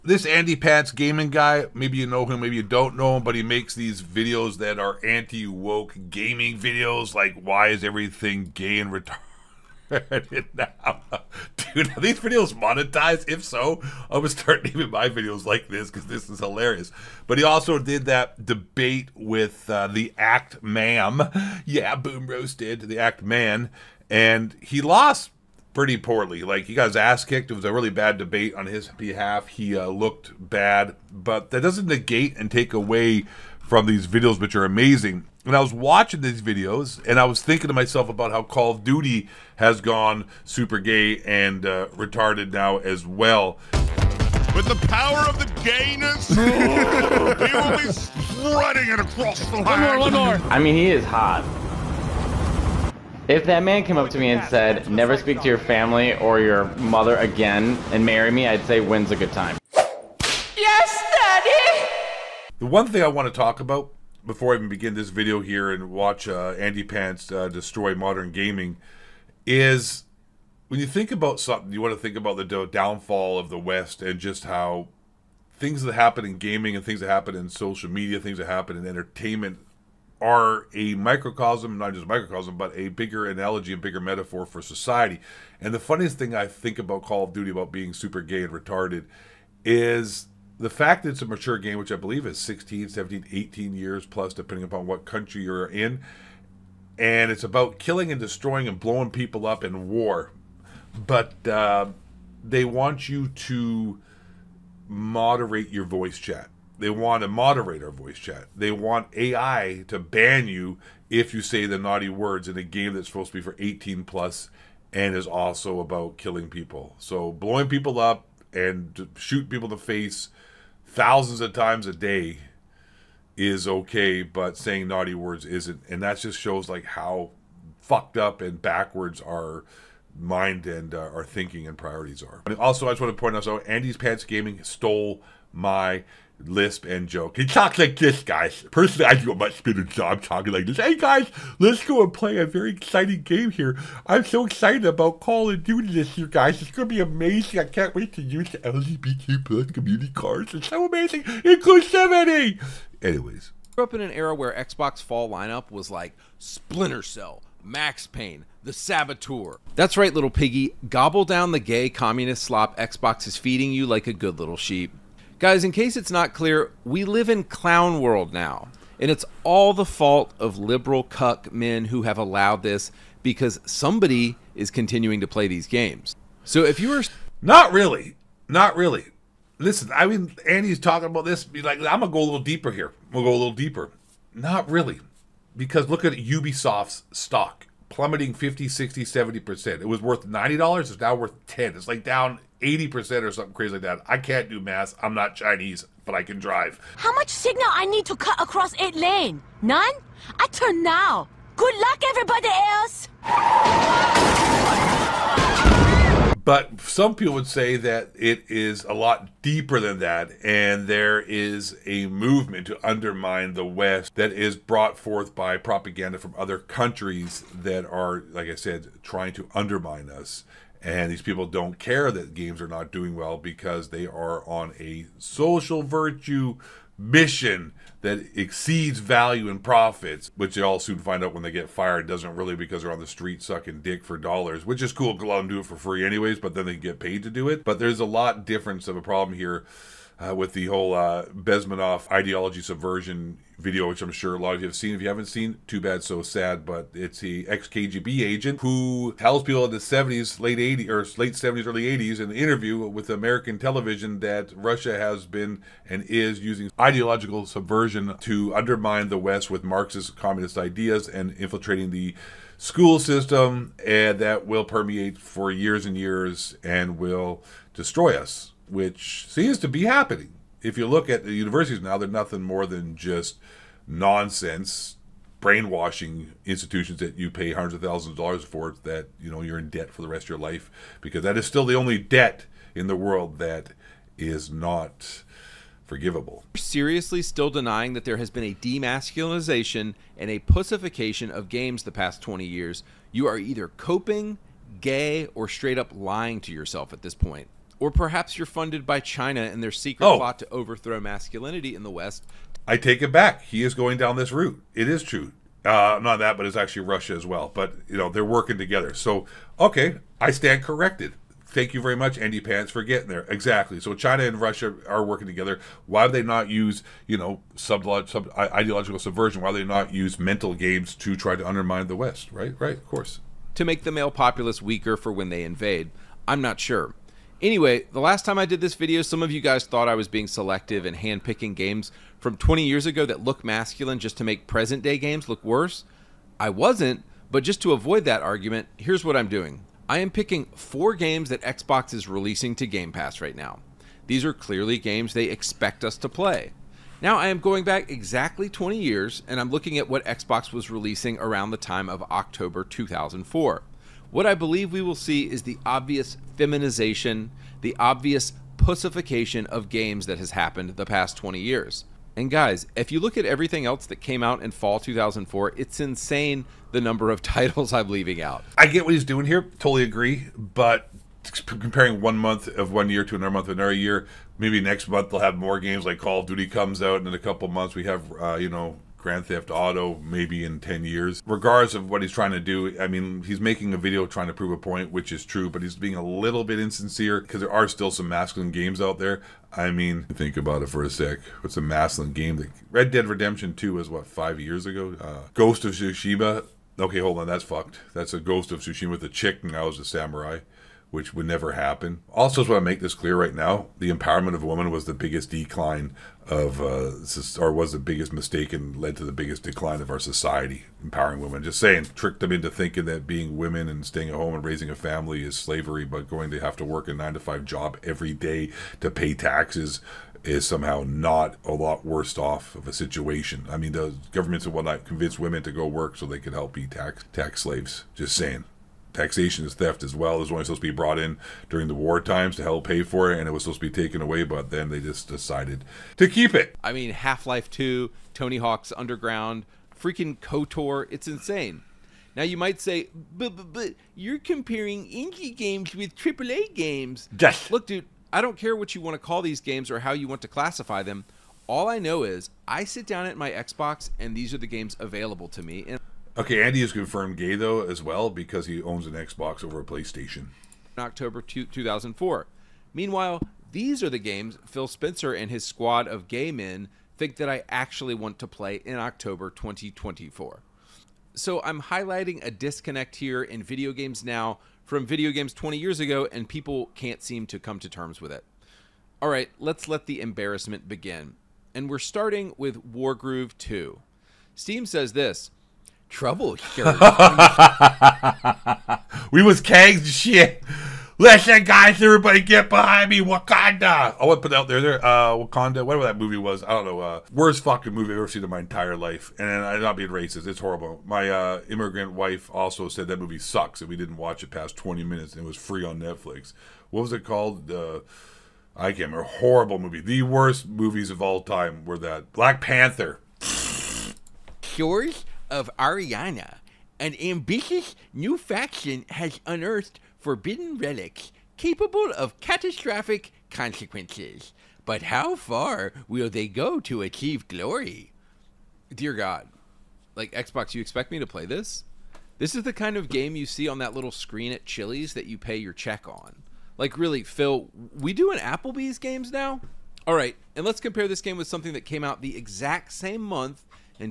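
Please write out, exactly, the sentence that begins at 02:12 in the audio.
And also, I just want to point out, so Andy's Pants Gaming stole my lisp and joke.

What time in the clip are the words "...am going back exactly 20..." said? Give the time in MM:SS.
05:47.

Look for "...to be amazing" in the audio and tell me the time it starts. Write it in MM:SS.
02:26.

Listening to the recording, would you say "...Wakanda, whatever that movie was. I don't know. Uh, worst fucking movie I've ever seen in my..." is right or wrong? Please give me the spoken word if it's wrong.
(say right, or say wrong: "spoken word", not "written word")
right.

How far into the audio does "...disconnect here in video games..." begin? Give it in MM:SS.
07:52.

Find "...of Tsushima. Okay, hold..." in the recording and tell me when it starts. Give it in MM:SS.
06:35.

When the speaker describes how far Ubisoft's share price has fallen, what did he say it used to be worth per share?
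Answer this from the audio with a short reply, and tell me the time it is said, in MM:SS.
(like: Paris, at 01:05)
$90, at 03:10.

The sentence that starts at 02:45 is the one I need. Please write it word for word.
Guys, in case it's not clear, we live in clown world now.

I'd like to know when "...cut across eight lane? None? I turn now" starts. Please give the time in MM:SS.
03:18.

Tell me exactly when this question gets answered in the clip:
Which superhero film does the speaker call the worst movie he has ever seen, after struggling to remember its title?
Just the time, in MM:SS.
08:32.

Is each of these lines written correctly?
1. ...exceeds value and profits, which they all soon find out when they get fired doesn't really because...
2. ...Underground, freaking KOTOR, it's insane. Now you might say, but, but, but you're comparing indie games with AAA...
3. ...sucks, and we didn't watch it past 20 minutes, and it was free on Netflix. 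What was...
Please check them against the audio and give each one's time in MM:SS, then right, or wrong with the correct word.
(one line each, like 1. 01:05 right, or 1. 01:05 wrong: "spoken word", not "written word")
1. 03:48 right
2. 07:18 right
3. 08:23 right.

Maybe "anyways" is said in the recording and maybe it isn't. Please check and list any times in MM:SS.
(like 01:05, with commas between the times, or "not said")
02:33, 03:56, 05:27.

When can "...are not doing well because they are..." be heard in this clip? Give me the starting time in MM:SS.
03:42.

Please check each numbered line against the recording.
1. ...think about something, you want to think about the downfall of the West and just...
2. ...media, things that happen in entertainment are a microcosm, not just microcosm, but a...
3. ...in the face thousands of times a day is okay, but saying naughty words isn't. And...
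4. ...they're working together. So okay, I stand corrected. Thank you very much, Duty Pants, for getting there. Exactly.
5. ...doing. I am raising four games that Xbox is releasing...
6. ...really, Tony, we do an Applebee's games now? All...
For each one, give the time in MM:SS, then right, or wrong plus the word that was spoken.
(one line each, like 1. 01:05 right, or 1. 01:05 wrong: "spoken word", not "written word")
1. 01:10 right
2. 01:17 right
3. 01:59 right
4. 05:08 wrong: "Andy", not "Duty"
5. 05:39 wrong: "picking", not "raising"
6. 08:56 wrong: "Phil", not "Tony".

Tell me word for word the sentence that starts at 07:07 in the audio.
Just saying taxation is theft as well.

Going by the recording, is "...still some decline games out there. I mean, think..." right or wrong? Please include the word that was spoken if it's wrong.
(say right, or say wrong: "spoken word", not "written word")
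wrong: "masculine", not "decline".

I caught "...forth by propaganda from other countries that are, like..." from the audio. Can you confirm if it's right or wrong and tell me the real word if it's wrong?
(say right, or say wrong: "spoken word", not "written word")
right.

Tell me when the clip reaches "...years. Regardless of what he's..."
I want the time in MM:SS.
06:20.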